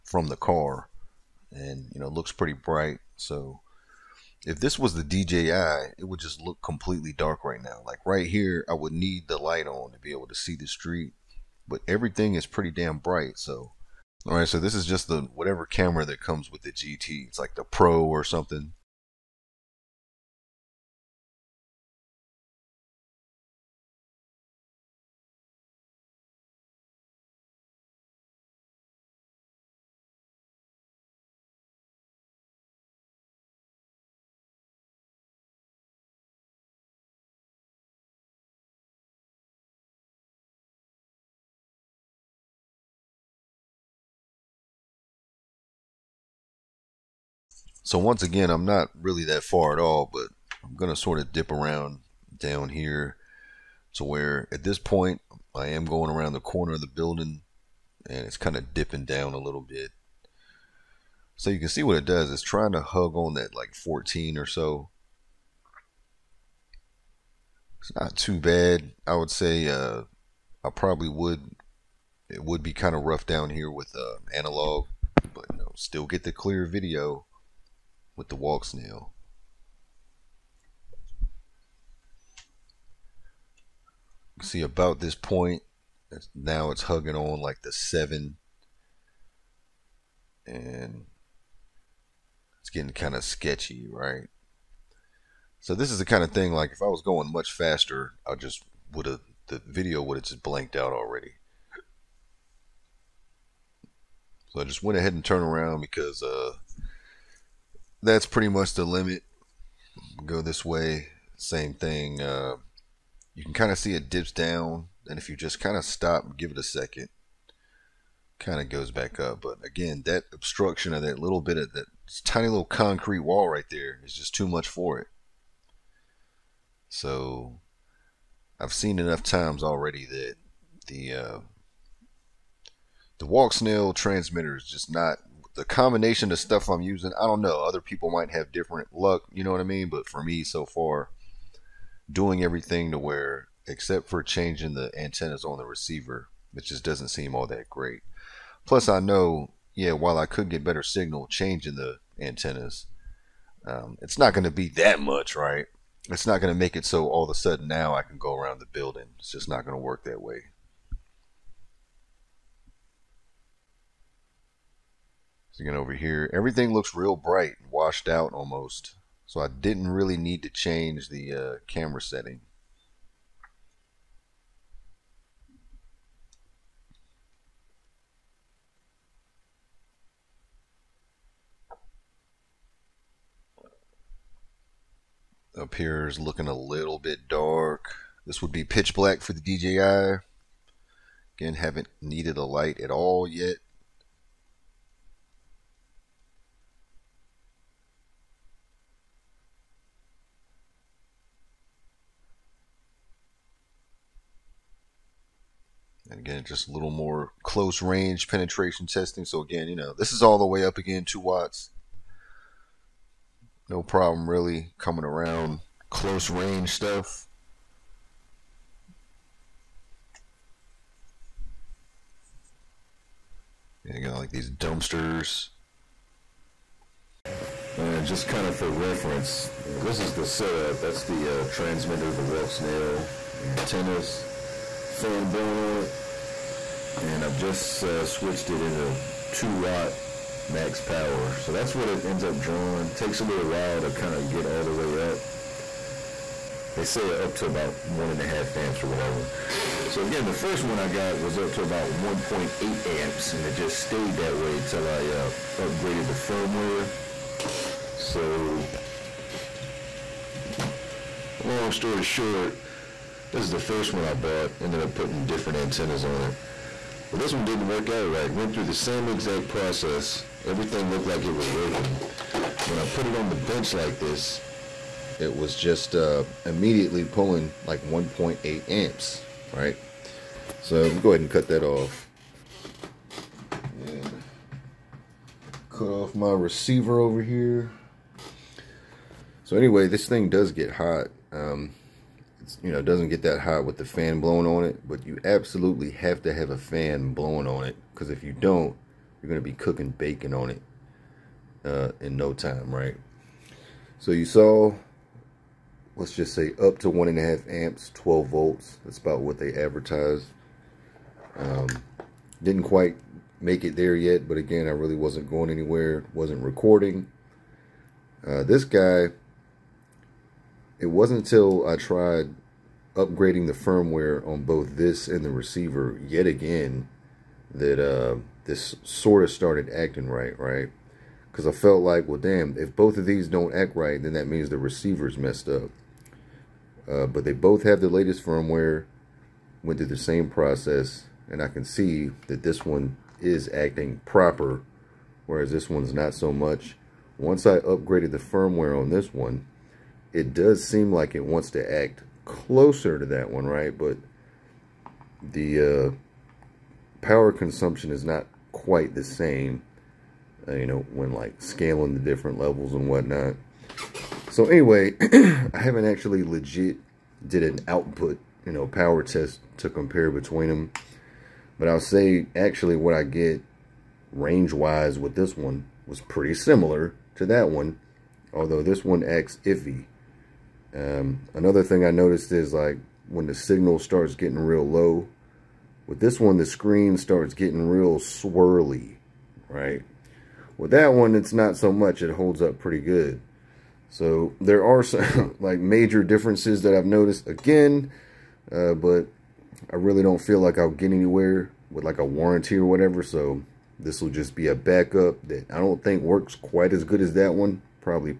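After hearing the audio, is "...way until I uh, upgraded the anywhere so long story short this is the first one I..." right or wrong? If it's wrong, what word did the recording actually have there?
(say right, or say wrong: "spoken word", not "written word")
wrong: "firmware", not "anywhere".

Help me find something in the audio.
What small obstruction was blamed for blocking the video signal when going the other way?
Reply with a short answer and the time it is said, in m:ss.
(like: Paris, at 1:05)
concrete wall, at 2:02.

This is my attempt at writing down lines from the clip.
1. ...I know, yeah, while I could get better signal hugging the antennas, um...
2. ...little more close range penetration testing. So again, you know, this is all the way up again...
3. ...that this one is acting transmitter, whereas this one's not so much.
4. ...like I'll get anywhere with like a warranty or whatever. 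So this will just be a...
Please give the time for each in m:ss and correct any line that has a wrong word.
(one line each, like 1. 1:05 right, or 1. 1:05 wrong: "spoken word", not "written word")
1. 2:28 wrong: "changing", not "hugging"
2. 3:26 right
3. 5:42 wrong: "proper", not "transmitter"
4. 6:40 right.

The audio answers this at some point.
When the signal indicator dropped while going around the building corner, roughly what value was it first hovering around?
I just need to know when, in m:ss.
1:03.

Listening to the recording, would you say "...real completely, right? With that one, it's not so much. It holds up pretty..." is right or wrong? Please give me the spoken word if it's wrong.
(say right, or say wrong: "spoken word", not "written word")
wrong: "swirly", not "completely".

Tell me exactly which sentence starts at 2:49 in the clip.
So I didn't really need to change the uh, camera setting.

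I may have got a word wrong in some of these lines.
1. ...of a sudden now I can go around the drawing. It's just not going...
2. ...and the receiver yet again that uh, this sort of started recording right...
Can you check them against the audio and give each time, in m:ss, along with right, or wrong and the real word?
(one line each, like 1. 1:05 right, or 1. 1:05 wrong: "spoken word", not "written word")
1. 2:37 wrong: "building", not "drawing"
2. 5:25 wrong: "acting", not "recording".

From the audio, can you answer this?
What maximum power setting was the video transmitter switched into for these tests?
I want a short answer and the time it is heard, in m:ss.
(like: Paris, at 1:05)
2 watt, at 3:59.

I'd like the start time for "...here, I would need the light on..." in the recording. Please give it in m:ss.
0:08.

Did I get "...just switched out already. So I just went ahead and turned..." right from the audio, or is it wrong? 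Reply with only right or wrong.
wrong.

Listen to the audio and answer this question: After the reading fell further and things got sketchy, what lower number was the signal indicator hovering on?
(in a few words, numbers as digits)
7.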